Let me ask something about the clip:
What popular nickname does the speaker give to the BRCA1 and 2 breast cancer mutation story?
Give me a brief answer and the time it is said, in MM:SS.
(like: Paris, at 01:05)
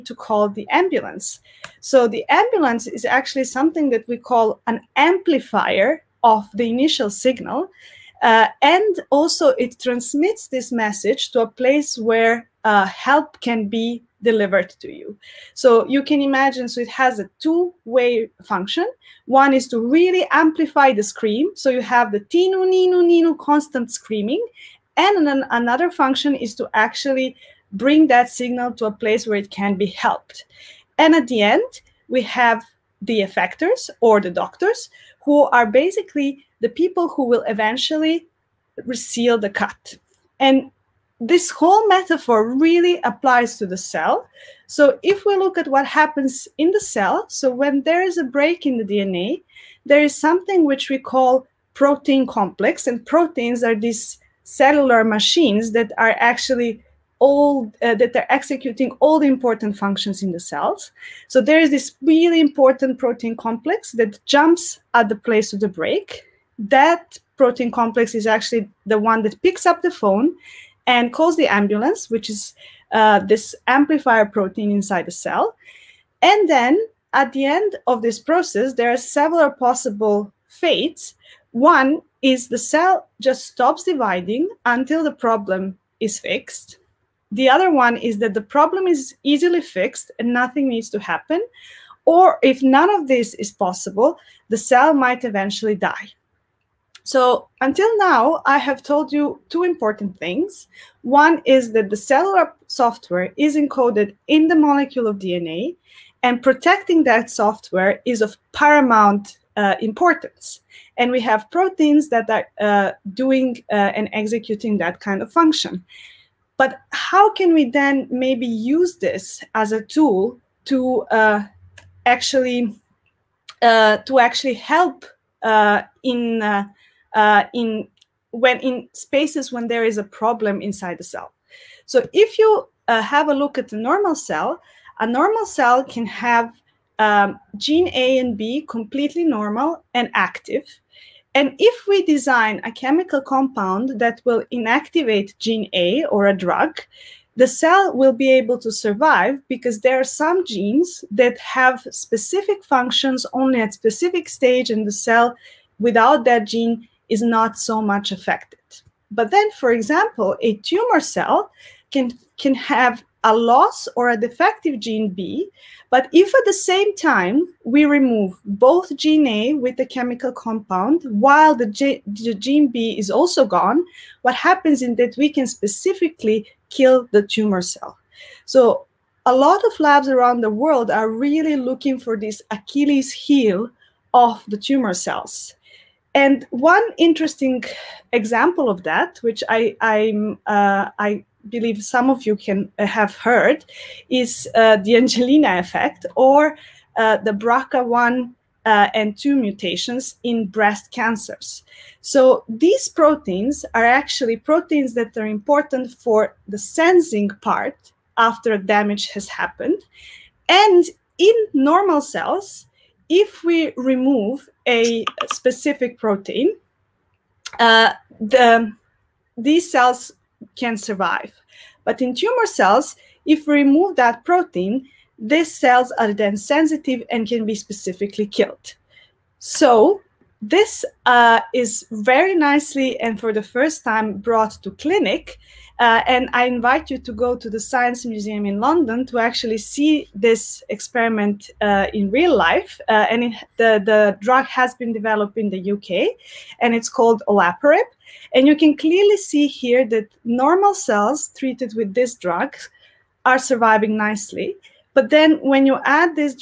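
The Angelina effect, at 03:14.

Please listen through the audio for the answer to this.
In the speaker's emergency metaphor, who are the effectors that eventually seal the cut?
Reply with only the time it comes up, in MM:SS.
00:34.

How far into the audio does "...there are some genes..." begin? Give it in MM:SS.
02:29.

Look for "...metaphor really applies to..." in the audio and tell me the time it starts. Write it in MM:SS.
00:41.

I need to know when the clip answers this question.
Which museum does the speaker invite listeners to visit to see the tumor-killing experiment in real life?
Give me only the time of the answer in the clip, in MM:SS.
03:57.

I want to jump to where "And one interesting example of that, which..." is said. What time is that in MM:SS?
03:06.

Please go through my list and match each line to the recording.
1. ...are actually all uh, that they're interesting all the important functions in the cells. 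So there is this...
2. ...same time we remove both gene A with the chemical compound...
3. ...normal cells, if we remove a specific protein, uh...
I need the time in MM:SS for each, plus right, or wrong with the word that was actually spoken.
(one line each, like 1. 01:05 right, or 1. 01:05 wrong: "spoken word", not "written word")
1. 00:55 wrong: "executing", not "interesting"
2. 02:46 right
3. 03:31 right.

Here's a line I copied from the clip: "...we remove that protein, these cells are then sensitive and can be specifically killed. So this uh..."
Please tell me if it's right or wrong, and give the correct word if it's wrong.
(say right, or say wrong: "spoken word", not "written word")
right.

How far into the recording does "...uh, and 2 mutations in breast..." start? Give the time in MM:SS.
03:18.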